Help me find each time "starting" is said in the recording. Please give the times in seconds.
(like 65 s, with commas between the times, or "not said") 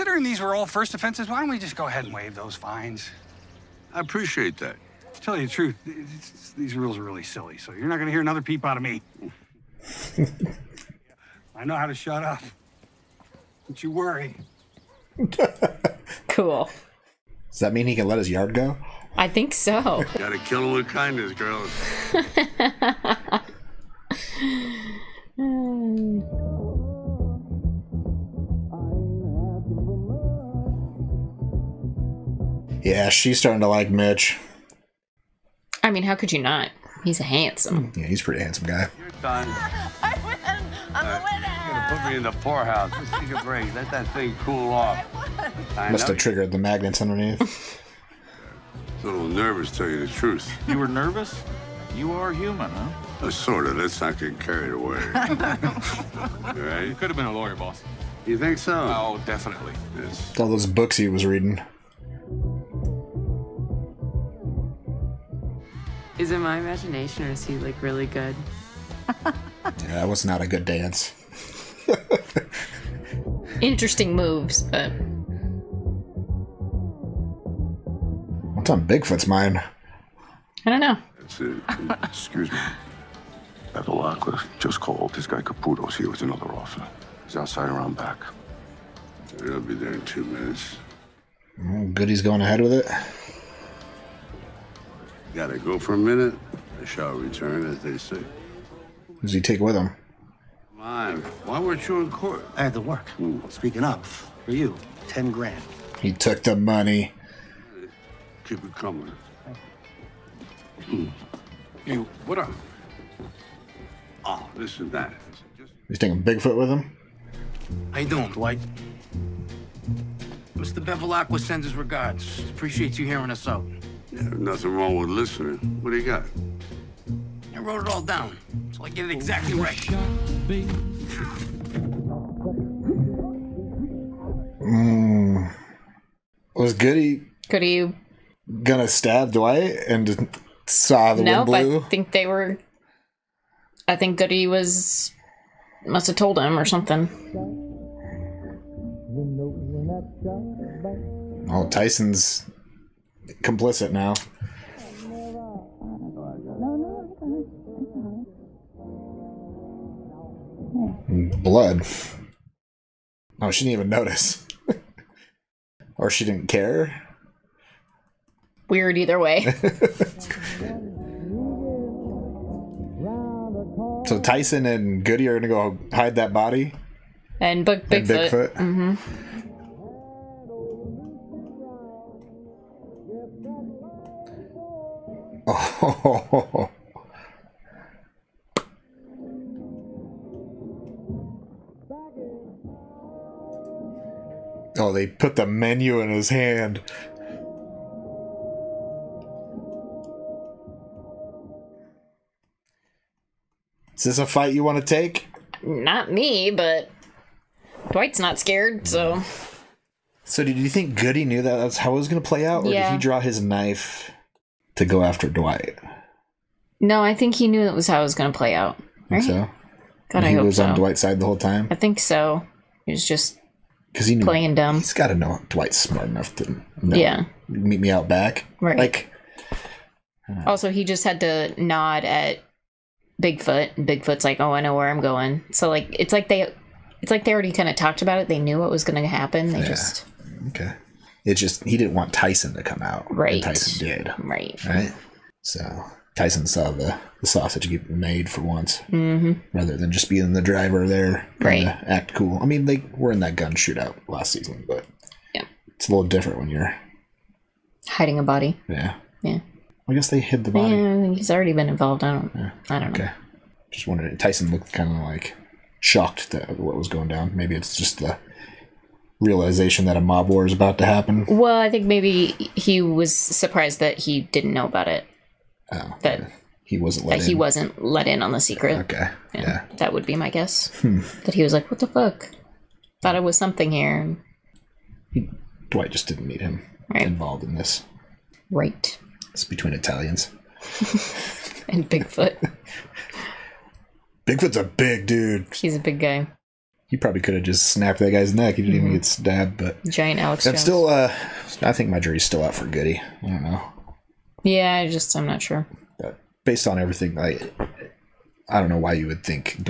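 33 s.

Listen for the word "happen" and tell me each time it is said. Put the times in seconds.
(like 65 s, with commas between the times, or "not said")
239 s, 270 s.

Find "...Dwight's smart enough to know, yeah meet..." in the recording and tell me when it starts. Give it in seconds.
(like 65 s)
225 s.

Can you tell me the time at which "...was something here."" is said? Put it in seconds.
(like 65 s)
283 s.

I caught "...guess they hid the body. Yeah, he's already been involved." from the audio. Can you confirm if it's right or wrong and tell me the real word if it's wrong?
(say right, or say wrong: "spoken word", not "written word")
right.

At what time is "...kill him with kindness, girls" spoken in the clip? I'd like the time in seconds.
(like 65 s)
20 s.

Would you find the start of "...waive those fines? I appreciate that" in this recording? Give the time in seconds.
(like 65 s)
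2 s.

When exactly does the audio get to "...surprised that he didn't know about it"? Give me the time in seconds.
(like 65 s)
273 s.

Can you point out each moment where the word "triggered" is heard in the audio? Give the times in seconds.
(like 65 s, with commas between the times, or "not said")
46 s.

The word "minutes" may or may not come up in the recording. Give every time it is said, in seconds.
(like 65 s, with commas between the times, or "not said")
90 s, 95 s.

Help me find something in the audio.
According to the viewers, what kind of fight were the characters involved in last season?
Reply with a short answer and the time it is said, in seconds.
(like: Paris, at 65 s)
gun shootout, at 253 s.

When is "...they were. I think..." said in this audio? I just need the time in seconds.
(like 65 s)
142 s.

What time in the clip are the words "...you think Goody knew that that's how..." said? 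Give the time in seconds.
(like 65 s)
210 s.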